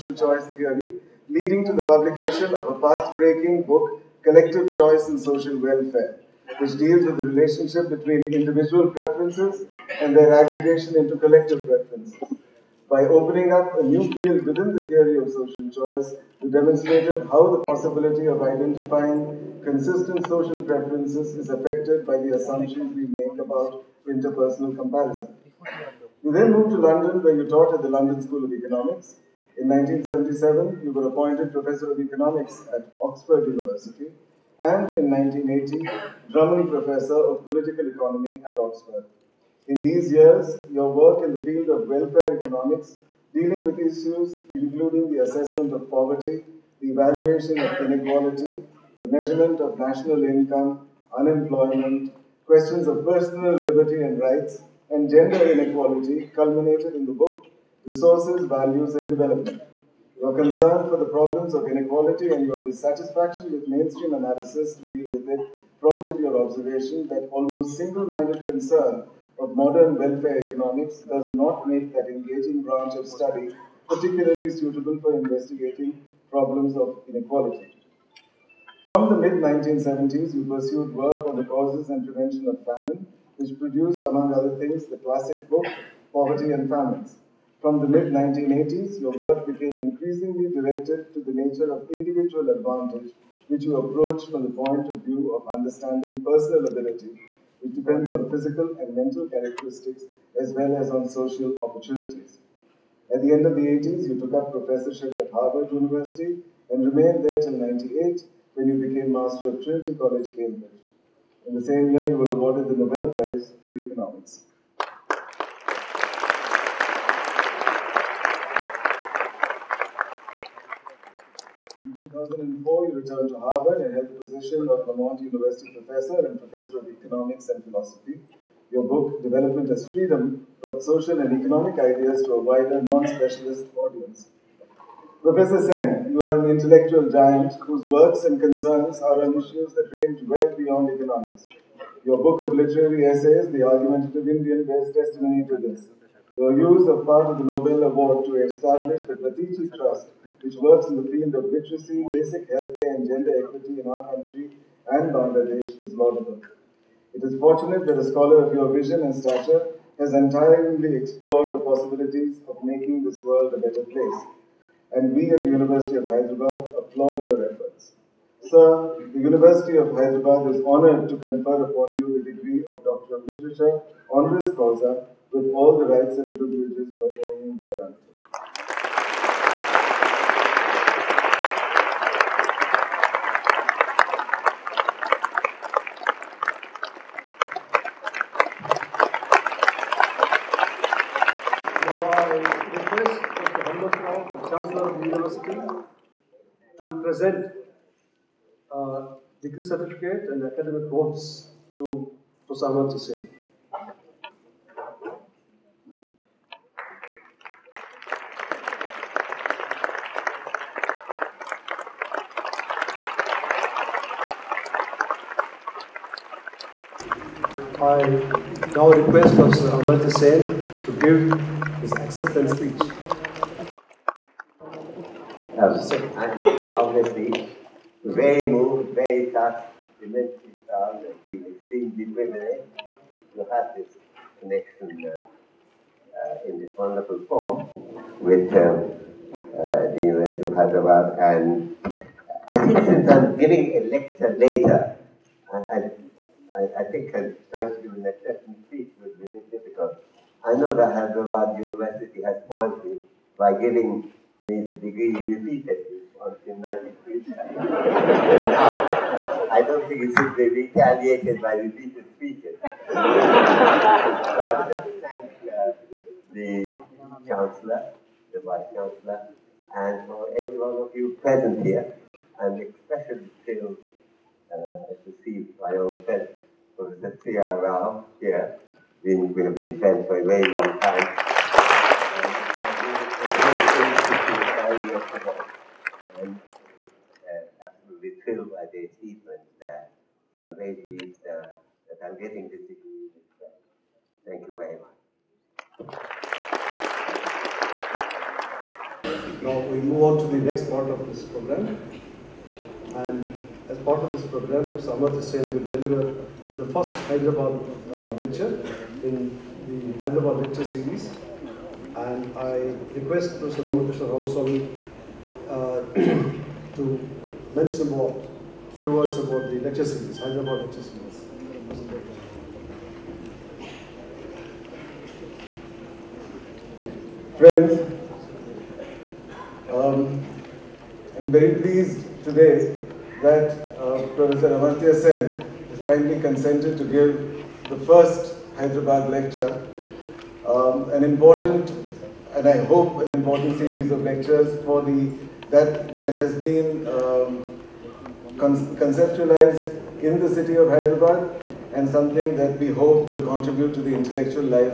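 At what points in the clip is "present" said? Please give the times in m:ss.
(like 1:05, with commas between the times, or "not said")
3:17, 4:31.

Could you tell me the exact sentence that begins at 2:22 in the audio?
Your book of literary essays, The Argumentative Indian, bears testimony to this.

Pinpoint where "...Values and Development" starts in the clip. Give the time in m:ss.
0:58.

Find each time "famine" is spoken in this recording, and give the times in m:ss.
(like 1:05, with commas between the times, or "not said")
1:22, 1:26.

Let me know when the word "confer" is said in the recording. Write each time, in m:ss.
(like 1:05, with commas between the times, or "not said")
2:51.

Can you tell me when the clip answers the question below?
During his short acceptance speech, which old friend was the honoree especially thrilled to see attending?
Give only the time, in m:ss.
4:36.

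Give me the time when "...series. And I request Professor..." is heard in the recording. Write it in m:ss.
5:10.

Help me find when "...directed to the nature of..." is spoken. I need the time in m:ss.
1:30.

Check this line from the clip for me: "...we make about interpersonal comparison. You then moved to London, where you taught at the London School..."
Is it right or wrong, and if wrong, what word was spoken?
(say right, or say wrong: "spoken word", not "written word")
right.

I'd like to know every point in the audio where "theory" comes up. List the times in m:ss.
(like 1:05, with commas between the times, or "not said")
0:00, 0:14.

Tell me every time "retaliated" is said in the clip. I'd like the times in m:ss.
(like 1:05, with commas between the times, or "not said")
4:20.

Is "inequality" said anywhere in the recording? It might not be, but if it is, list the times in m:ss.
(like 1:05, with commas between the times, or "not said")
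0:47, 0:55, 1:01, 1:17.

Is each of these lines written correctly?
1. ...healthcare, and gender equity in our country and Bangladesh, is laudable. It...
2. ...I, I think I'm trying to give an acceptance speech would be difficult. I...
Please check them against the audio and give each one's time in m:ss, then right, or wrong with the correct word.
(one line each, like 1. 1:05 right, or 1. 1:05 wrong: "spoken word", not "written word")
1. 2:32 right
2. 4:05 right.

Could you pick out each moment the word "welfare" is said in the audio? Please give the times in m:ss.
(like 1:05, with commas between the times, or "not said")
0:05, 0:41, 1:10.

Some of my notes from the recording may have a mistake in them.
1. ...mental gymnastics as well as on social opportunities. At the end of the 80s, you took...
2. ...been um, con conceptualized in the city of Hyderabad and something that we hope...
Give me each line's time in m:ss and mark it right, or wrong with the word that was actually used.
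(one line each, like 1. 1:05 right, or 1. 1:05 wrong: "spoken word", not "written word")
1. 1:38 wrong: "characteristics", not "gymnastics"
2. 5:46 right.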